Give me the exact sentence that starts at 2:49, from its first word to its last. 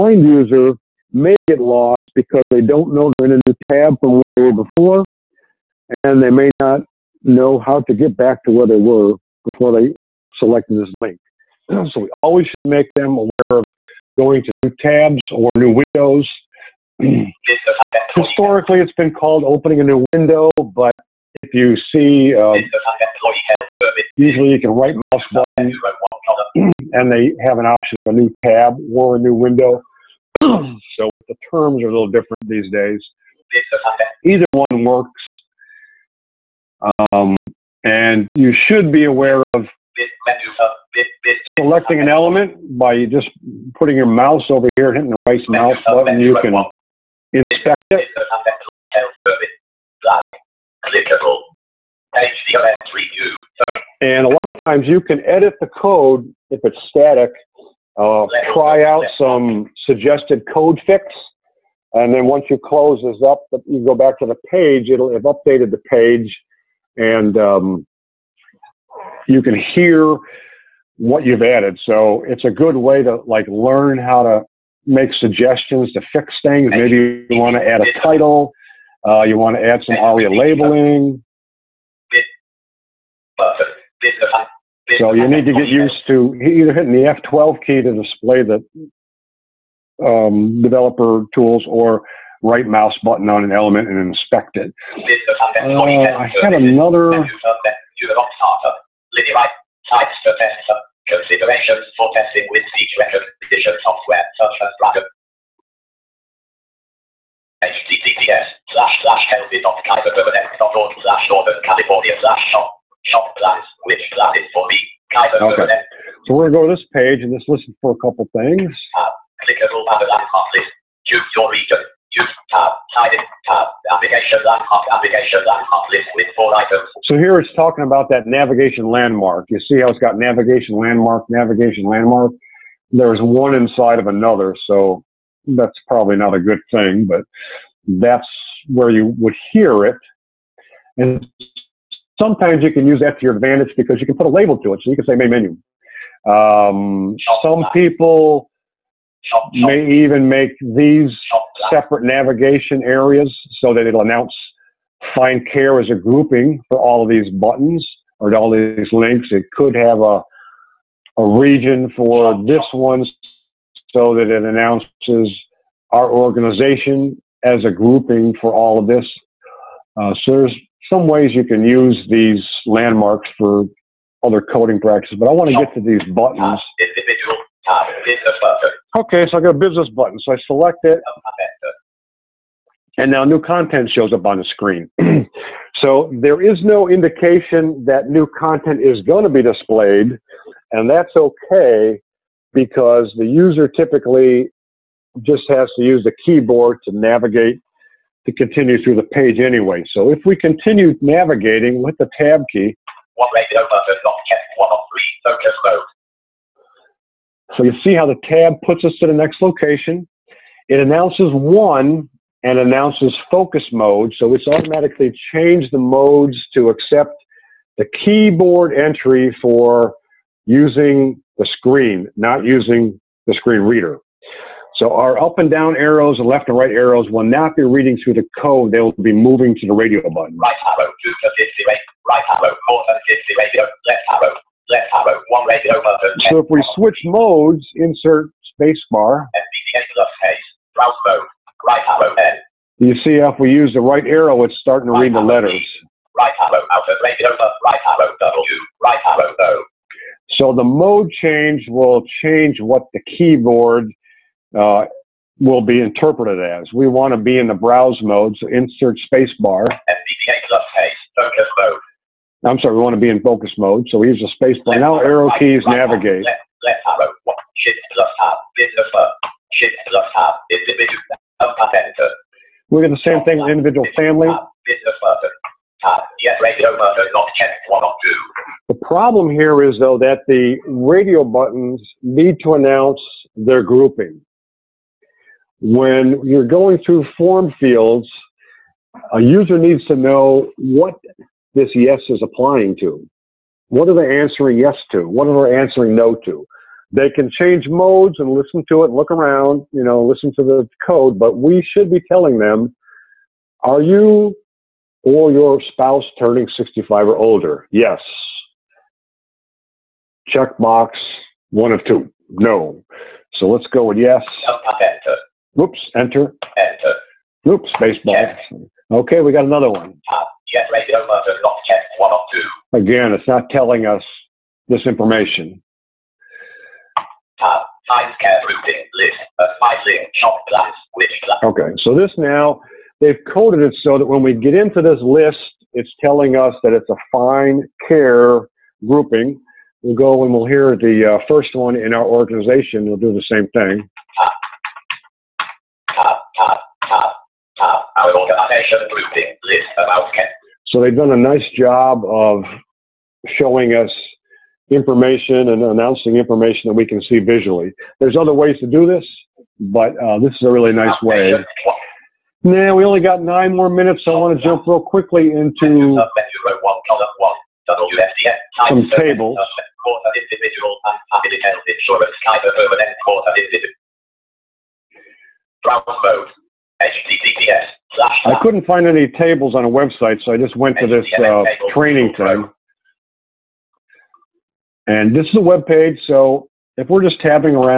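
Uh, so there's some ways you can use these landmarks for other coding practices, but I want to get to these buttons.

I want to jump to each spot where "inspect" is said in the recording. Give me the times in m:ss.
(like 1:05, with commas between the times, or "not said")
0:47, 1:33.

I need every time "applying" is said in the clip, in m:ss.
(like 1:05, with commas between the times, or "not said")
4:52.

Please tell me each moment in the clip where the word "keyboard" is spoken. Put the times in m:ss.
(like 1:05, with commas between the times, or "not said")
3:16, 3:38, 4:13.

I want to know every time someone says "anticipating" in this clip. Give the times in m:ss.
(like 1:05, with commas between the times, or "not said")
not said.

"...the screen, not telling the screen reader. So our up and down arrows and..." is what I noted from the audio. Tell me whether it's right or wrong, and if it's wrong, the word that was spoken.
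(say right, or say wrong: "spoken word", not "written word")
wrong: "using", not "telling".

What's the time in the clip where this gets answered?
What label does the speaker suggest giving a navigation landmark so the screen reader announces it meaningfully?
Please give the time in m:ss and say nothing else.
2:25.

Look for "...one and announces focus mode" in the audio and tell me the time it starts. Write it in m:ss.
3:31.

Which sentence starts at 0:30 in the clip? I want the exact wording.
so if the terms are a little different these days, either one works.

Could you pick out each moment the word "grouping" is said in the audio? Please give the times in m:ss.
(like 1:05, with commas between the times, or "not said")
2:35, 2:47, 4:43, 5:38, 5:48.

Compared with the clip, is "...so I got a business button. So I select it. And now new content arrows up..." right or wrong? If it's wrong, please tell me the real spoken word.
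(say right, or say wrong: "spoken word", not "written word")
wrong: "shows", not "arrows".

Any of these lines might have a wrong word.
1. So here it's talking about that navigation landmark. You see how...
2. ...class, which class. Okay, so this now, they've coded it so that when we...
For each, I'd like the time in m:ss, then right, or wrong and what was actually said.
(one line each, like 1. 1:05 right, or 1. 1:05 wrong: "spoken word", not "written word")
1. 2:07 right
2. 5:30 right.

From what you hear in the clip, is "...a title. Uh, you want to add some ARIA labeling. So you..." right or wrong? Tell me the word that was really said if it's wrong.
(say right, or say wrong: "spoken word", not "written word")
right.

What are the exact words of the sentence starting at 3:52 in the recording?
Right arrow, more than 50 radio.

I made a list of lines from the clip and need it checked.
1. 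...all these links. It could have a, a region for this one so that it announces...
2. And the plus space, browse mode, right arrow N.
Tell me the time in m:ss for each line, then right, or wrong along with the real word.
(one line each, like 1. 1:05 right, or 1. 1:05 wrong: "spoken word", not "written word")
1. 2:38 right
2. 3:59 right.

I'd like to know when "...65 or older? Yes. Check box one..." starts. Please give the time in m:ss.
5:06.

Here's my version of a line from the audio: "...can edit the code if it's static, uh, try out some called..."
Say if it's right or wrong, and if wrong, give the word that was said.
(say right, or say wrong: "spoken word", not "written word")
wrong: "suggested", not "called".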